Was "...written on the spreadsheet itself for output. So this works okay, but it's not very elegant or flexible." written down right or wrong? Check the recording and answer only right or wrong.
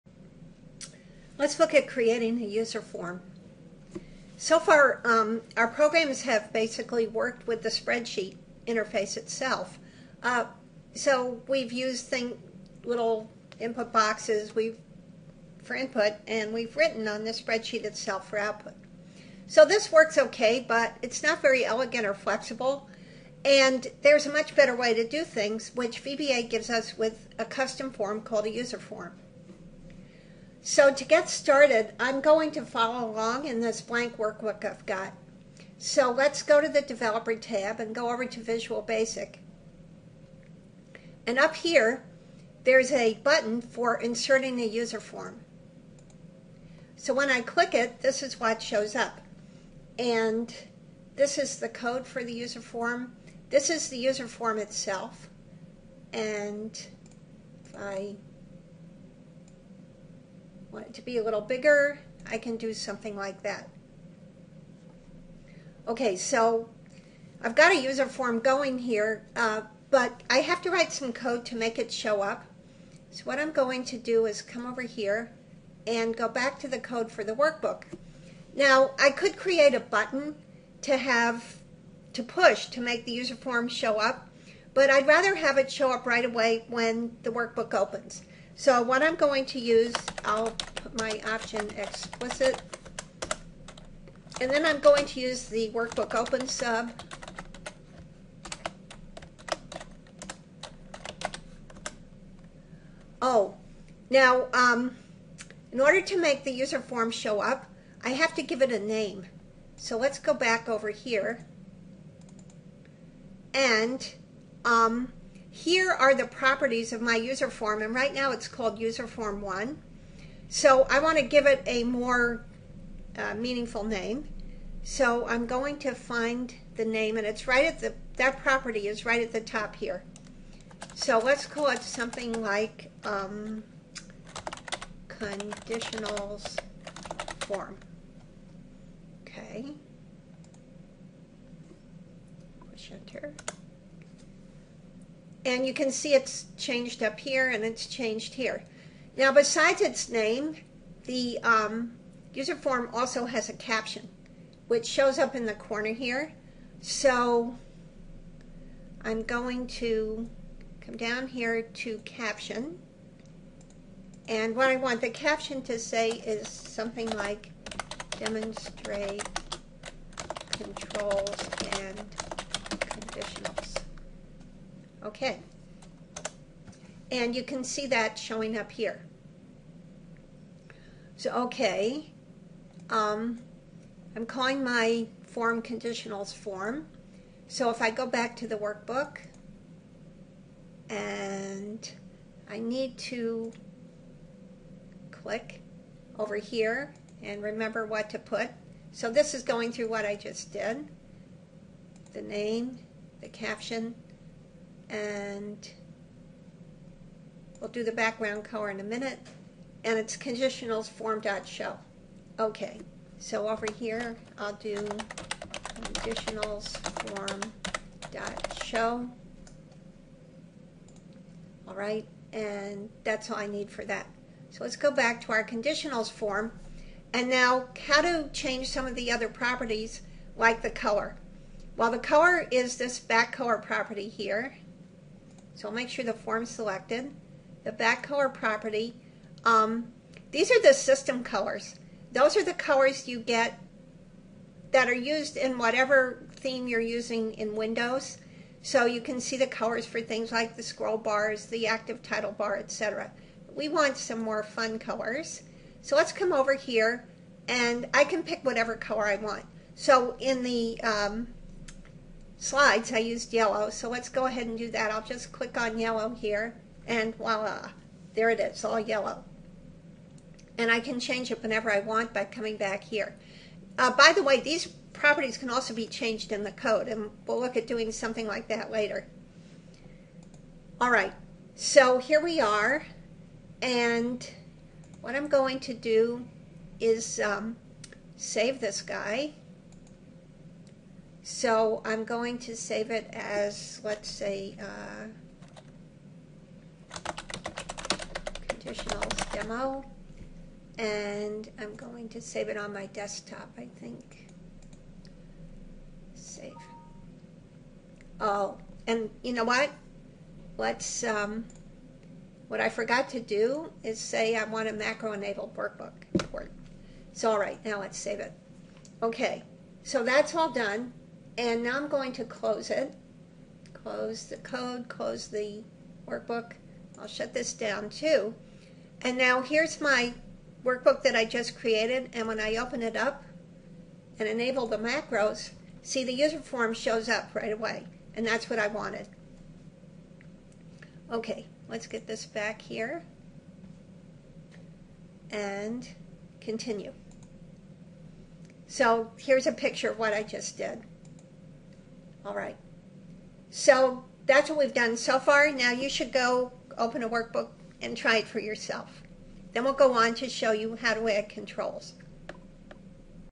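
right.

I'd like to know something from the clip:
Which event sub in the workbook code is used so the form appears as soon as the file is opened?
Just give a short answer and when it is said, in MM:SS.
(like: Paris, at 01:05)
workbook open, at 01:35.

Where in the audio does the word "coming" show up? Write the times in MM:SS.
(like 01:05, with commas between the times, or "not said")
04:32.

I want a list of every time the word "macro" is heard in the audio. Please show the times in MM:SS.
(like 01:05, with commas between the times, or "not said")
05:14, 05:34.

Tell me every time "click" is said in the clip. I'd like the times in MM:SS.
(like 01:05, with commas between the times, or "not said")
00:47, 03:15, 04:25.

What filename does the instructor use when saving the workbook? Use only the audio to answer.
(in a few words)
conditionals demo.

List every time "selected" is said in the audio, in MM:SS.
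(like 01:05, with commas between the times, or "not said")
03:56.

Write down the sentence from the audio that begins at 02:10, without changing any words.
So let's call it something like um, conditionals form.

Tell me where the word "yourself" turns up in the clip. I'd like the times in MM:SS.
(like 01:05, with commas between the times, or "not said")
05:58.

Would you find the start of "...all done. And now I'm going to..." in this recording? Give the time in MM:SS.
05:20.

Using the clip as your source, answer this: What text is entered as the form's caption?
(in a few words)
demonstrate controls and conditionals.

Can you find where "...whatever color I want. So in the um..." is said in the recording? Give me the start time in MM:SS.
04:18.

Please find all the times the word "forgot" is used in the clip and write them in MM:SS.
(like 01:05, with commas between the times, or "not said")
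05:12.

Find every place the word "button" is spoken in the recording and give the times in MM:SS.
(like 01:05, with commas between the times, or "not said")
00:43, 01:19.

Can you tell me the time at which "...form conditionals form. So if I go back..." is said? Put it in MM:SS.
03:05.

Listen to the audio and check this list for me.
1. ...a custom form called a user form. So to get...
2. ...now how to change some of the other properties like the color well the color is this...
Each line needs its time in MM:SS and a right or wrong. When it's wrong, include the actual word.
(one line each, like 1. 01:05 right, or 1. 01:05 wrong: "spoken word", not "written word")
1. 00:27 right
2. 03:47 right.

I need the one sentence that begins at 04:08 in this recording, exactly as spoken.
So you can see the colors for things like the scroll bars, the active title bar, etc.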